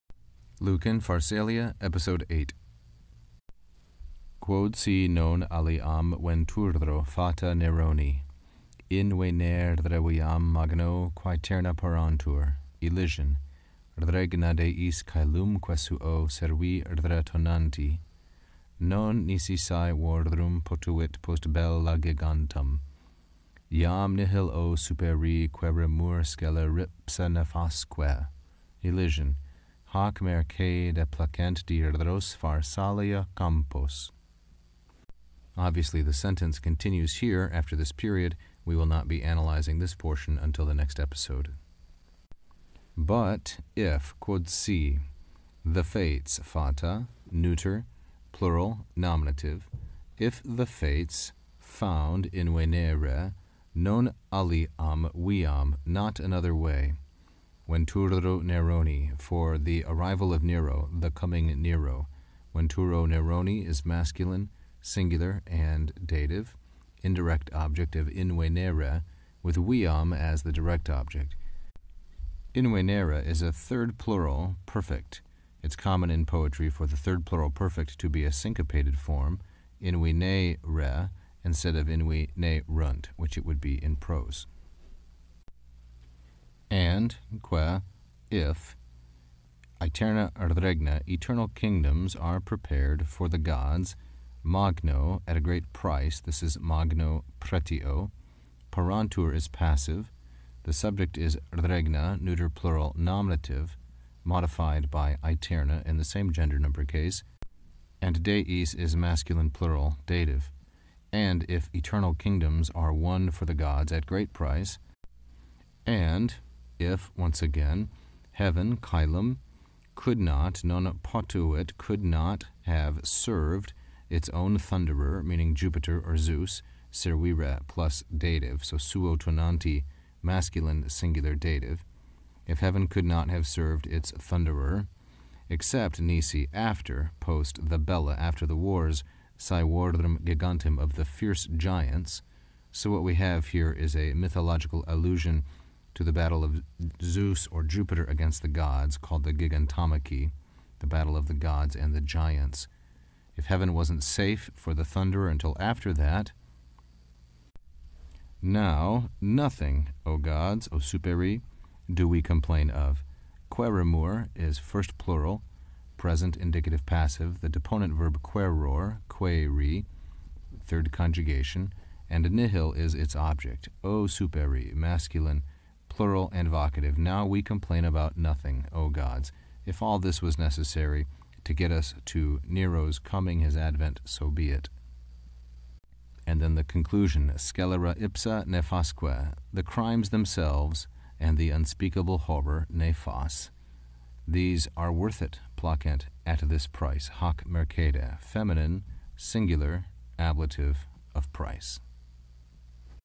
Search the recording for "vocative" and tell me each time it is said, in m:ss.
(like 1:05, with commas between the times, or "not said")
2:56.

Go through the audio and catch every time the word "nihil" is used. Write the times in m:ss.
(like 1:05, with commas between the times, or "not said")
0:24, 2:52.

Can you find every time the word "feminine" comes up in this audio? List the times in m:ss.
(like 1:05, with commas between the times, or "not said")
3:18.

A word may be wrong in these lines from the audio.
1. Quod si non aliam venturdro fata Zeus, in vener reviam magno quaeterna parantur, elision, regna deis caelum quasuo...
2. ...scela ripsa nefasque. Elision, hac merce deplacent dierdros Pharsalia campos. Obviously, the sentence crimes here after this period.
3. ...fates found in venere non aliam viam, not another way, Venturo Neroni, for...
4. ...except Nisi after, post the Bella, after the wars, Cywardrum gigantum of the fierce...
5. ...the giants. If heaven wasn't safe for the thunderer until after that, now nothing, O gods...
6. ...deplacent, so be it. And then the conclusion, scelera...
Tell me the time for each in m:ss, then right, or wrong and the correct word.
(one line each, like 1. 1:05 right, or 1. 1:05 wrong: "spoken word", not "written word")
1. 0:04 wrong: "Neroni", not "Zeus"
2. 0:26 wrong: "continues", not "crimes"
3. 0:50 right
4. 2:15 right
5. 2:31 right
6. 3:03 wrong: "advent", not "deplacent".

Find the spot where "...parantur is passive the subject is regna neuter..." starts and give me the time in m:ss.
1:38.